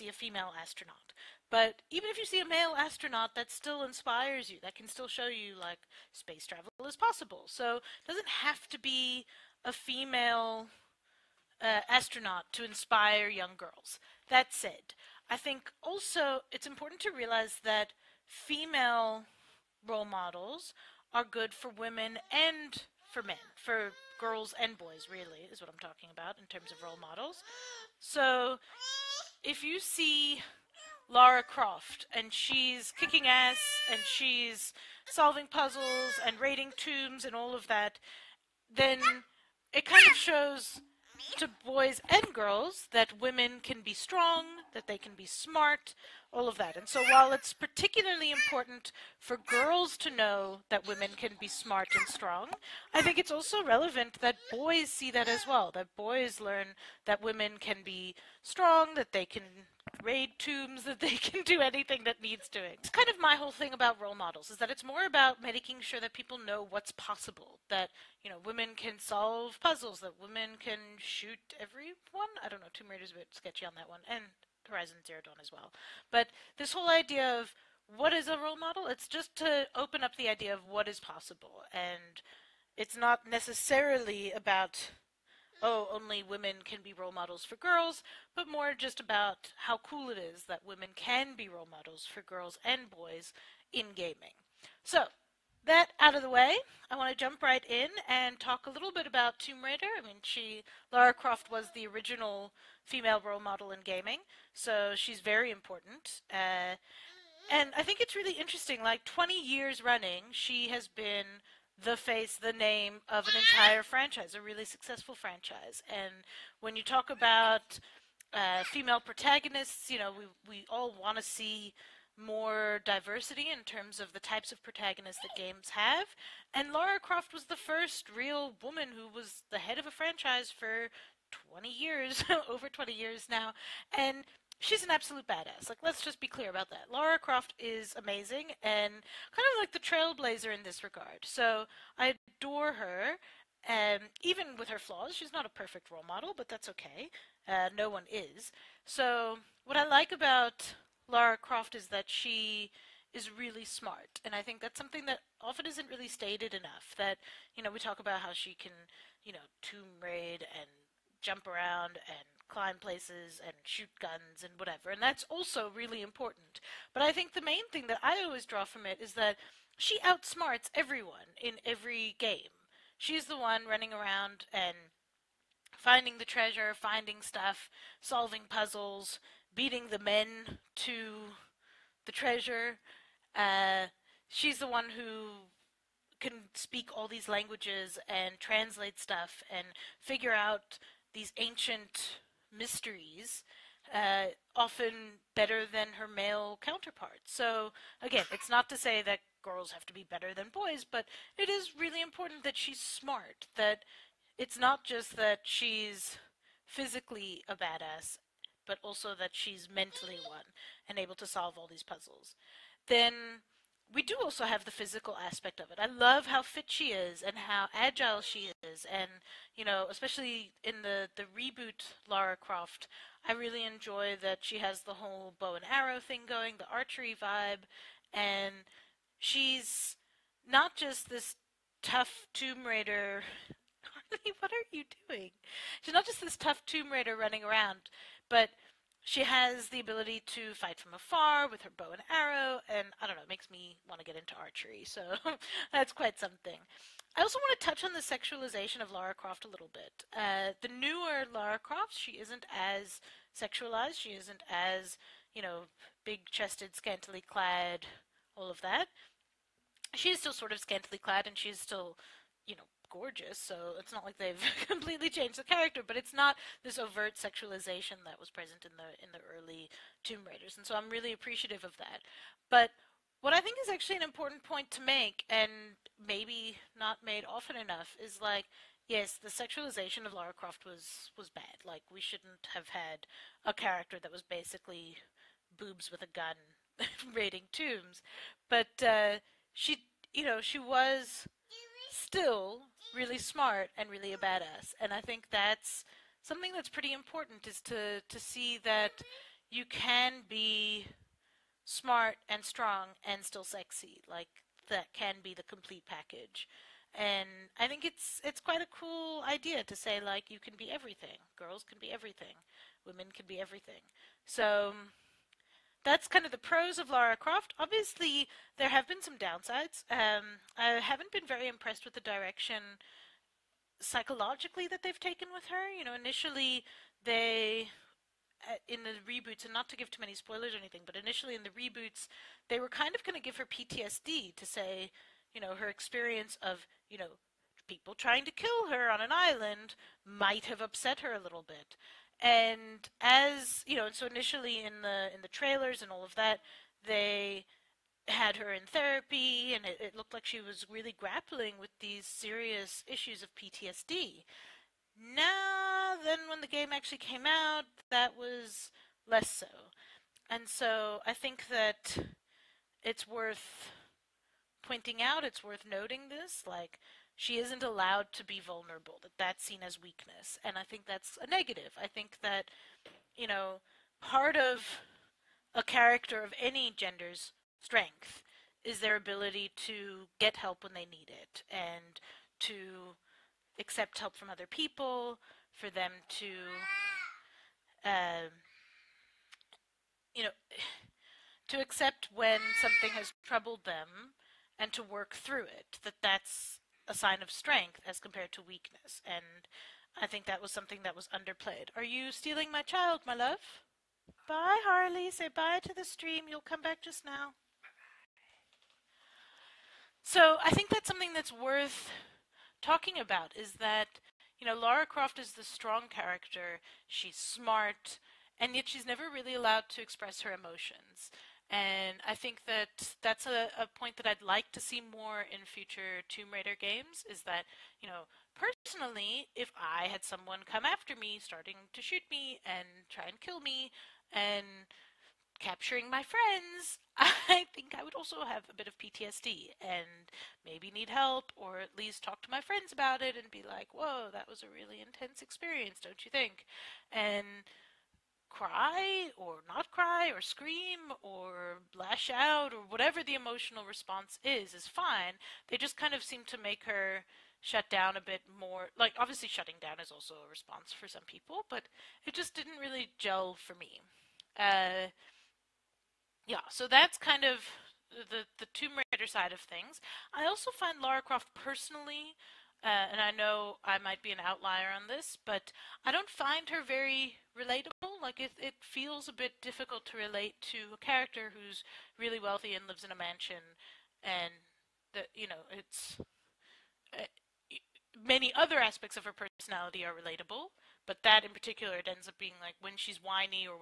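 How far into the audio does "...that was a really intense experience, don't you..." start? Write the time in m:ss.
7:24.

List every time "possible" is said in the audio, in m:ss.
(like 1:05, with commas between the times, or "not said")
0:06, 1:06, 1:20.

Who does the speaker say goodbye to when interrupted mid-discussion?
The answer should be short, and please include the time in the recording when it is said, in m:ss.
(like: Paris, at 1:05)
Harley, at 6:44.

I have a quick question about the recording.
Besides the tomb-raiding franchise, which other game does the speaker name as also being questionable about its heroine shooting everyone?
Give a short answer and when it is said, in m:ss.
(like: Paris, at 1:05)
Horizon Zero Dawn, at 1:14.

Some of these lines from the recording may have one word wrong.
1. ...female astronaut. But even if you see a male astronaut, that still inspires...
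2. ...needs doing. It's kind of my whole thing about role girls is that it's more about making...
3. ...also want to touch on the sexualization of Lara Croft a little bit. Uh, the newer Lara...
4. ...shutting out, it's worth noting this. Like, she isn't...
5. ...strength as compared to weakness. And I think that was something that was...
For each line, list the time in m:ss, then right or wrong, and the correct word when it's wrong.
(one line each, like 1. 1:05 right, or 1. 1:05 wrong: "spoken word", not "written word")
1. 0:00 right
2. 1:02 wrong: "models", not "girls"
3. 4:07 right
4. 6:04 wrong: "pointing", not "shutting"
5. 6:37 right.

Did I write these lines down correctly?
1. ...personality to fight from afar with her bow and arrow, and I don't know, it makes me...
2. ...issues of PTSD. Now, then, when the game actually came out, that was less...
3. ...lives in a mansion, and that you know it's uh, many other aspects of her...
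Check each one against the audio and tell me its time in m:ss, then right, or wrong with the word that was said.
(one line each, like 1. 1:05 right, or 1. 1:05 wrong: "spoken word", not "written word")
1. 3:59 wrong: "ability", not "personality"
2. 5:52 right
3. 8:02 right.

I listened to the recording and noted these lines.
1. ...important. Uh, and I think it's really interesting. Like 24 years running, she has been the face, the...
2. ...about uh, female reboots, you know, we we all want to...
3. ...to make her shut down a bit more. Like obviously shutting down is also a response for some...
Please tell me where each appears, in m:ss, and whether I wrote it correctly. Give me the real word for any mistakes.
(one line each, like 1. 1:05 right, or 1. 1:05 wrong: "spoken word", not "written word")
1. 1:45 wrong: "20", not "24"
2. 1:57 wrong: "protagonists", not "reboots"
3. 7:36 right.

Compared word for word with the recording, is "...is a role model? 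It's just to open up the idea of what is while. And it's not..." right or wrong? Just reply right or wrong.
wrong.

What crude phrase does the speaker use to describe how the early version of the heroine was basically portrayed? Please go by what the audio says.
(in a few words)
Boobs with a gun.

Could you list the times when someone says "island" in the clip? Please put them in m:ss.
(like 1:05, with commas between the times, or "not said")
5:39.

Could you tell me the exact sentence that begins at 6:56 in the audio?
She's smart, and yet she's never really allowed to express her emotions.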